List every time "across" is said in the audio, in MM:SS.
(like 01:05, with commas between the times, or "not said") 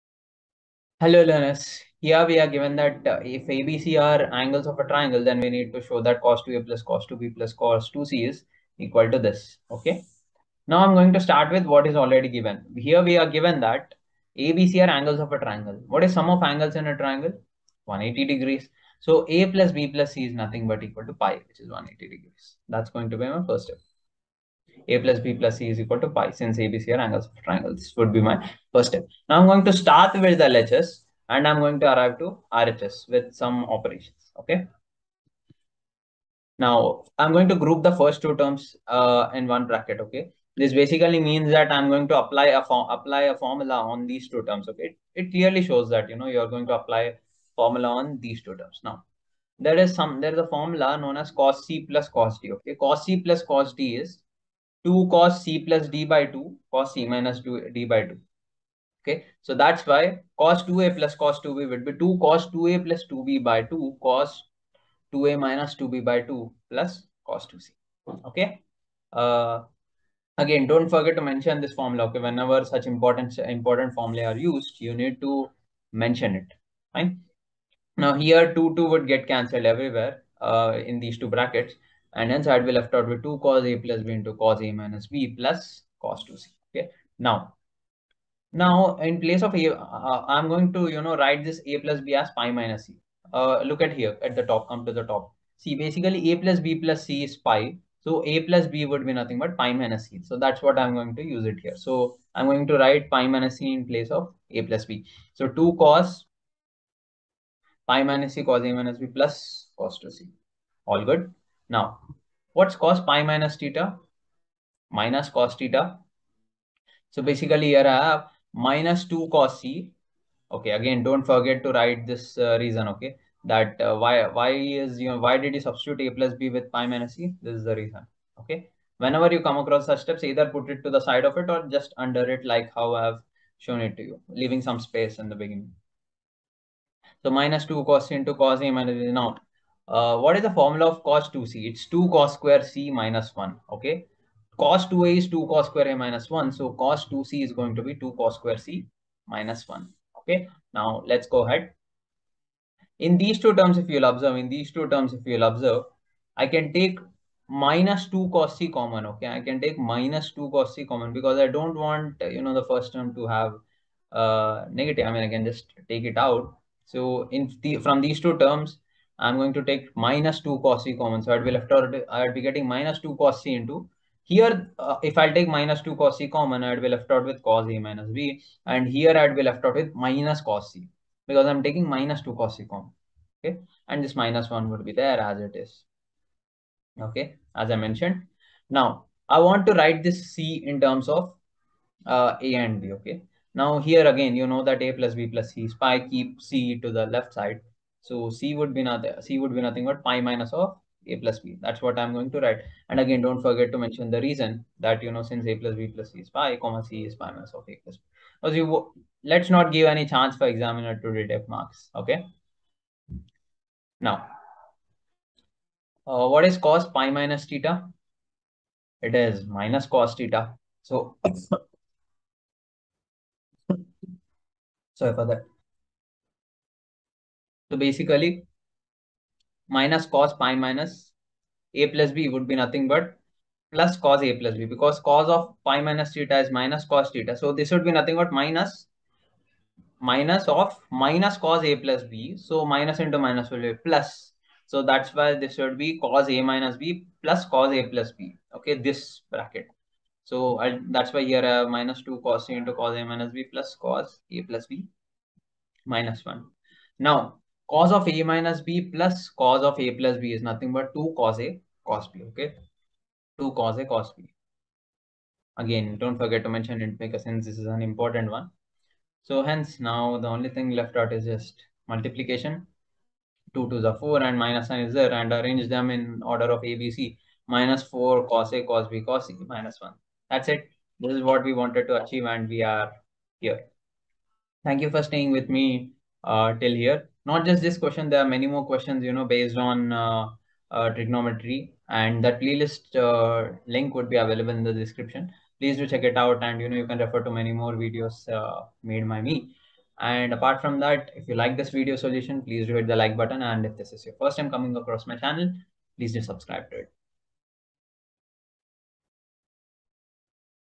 02:09, 05:04.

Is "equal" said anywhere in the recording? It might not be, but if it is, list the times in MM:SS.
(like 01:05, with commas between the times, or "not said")
00:08, 00:20, 00:25.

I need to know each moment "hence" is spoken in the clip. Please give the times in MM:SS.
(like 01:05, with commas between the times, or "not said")
01:22, 04:29.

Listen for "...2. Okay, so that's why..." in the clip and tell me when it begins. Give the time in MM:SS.
00:58.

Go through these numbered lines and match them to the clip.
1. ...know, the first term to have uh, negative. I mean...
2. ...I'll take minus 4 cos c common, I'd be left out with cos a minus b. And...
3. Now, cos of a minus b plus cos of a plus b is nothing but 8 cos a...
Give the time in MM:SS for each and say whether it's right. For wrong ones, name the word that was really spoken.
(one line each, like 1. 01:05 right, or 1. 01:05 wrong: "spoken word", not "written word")
1. 02:42 right
2. 02:55 wrong: "2", not "4"
3. 04:16 wrong: "2", not "8".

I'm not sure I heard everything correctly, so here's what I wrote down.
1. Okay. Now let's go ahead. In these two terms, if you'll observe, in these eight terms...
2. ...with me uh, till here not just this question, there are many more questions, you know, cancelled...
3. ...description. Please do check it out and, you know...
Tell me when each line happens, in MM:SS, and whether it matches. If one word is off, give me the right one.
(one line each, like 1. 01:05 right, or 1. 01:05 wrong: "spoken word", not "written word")
1. 02:30 wrong: "two", not "eight"
2. 04:45 wrong: "based", not "cancelled"
3. 04:54 right.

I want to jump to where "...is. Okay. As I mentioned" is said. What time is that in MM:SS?
03:05.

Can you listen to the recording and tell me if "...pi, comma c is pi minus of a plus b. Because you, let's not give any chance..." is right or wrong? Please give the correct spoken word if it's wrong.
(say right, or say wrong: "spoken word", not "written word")
right.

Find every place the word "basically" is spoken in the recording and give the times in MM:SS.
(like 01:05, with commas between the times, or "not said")
00:40, 01:35, 01:57, 03:47.